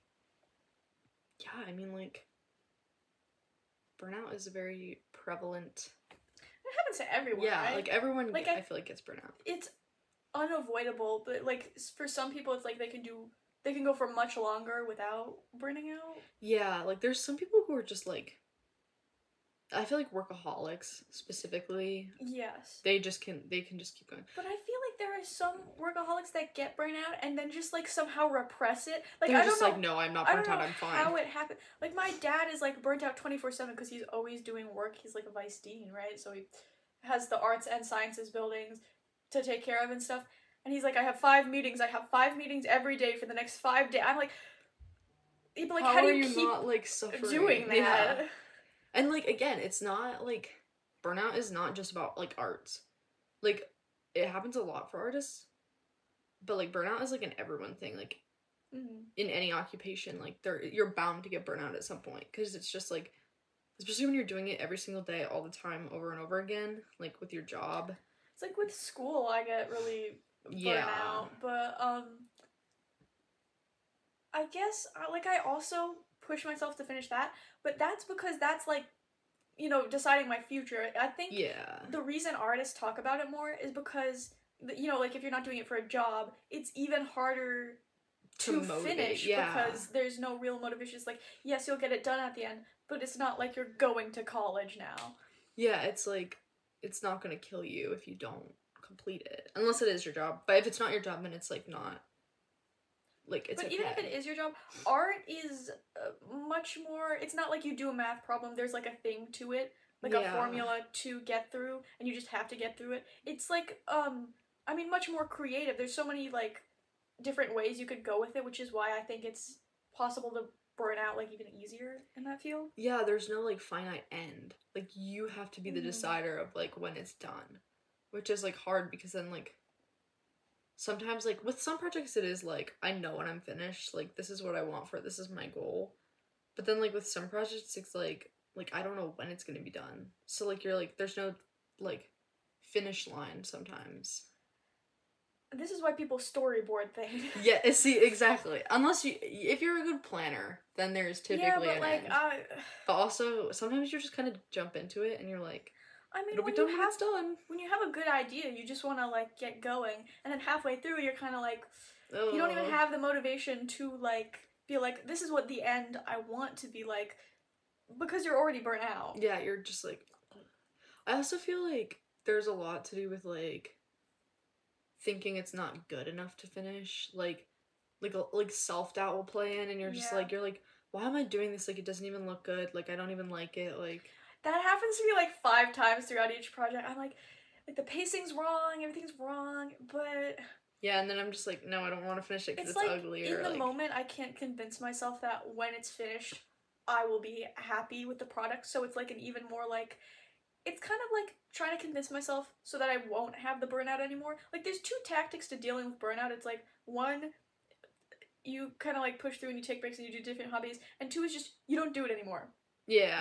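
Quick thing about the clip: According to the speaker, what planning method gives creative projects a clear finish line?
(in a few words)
Storyboard.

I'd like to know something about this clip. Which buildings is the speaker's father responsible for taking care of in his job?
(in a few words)
Arts and sciences buildings.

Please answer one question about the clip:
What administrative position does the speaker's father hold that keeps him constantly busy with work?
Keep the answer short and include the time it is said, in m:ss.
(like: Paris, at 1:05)
Vice dean, at 0:35.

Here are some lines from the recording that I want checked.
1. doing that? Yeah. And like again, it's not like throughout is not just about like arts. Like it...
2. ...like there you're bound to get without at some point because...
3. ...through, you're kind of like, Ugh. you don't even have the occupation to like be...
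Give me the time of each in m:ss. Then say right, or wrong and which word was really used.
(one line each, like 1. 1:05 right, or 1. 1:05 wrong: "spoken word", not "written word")
1. 0:47 wrong: "burnout", not "throughout"
2. 1:00 wrong: "burnout", not "without"
3. 2:40 wrong: "motivation", not "occupation".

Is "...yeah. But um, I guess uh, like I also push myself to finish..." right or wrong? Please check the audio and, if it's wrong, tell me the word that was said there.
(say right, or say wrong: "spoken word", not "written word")
right.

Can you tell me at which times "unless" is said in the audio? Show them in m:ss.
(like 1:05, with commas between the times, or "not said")
1:39, 2:28.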